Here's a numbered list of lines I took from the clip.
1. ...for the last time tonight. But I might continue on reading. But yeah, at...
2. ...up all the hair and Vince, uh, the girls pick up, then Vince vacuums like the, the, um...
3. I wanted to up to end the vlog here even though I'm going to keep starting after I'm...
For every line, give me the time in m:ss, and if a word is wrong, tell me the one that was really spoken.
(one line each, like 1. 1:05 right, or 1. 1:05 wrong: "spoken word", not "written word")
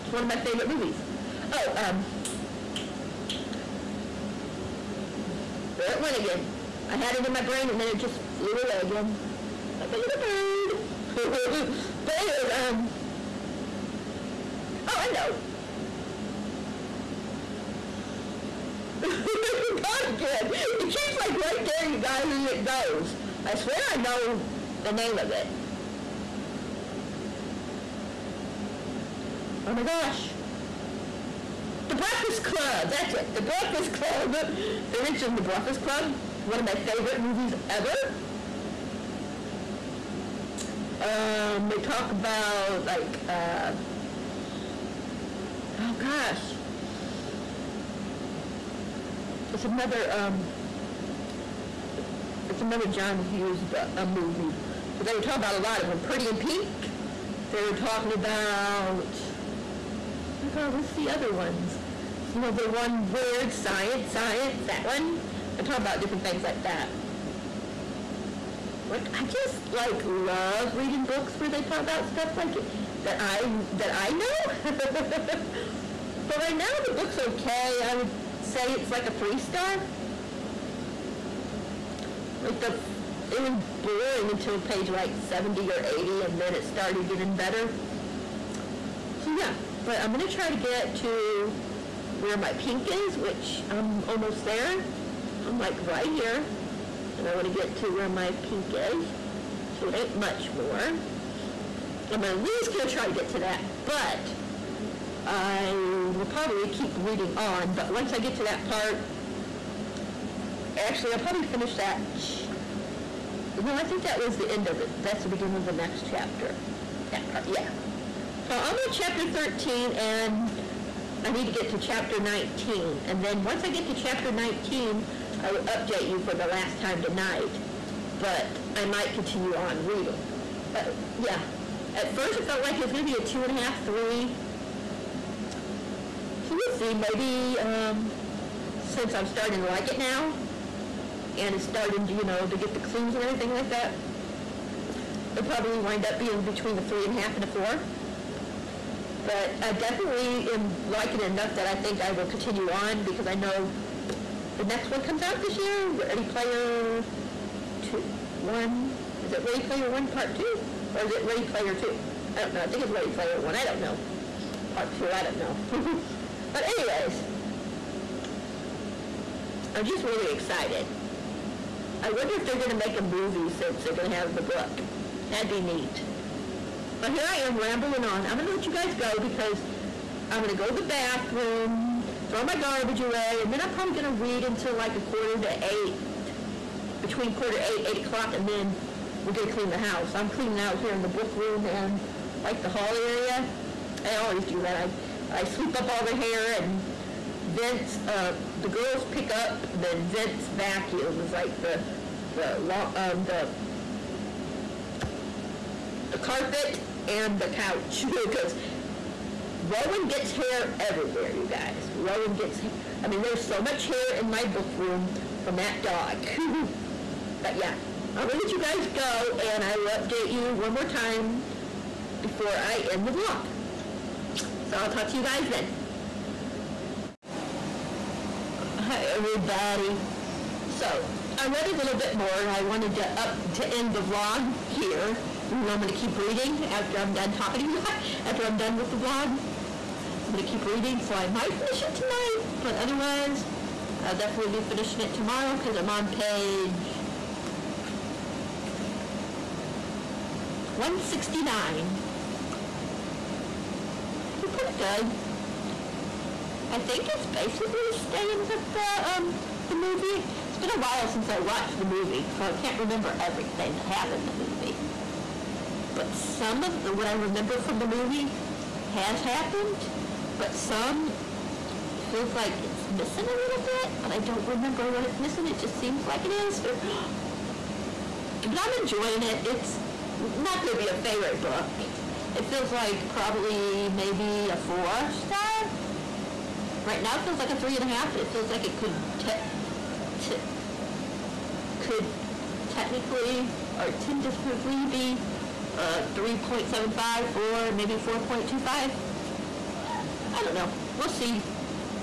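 1. 2:06 right
2. 3:15 right
3. 3:52 wrong: "reading", not "starting".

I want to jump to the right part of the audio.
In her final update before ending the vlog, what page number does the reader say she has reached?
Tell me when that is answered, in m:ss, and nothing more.
4:06.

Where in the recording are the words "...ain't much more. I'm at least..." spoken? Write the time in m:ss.
1:39.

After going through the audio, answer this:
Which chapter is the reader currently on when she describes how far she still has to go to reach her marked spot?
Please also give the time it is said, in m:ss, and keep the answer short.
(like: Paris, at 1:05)
13, at 1:58.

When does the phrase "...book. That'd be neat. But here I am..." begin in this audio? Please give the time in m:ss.
2:54.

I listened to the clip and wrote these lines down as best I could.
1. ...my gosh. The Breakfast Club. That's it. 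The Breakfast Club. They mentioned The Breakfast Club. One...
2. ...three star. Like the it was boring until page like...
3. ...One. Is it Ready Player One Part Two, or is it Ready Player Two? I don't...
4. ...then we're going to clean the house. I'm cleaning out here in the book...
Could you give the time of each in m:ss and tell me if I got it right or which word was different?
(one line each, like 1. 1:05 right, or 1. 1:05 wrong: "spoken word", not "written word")
1. 0:29 right
2. 1:19 right
3. 2:38 right
4. 3:08 right.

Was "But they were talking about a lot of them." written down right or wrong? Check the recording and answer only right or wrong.
right.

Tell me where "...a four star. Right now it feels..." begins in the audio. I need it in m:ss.
4:44.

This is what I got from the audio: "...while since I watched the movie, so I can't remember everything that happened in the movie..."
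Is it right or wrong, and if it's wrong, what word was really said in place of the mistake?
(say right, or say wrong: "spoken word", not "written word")
right.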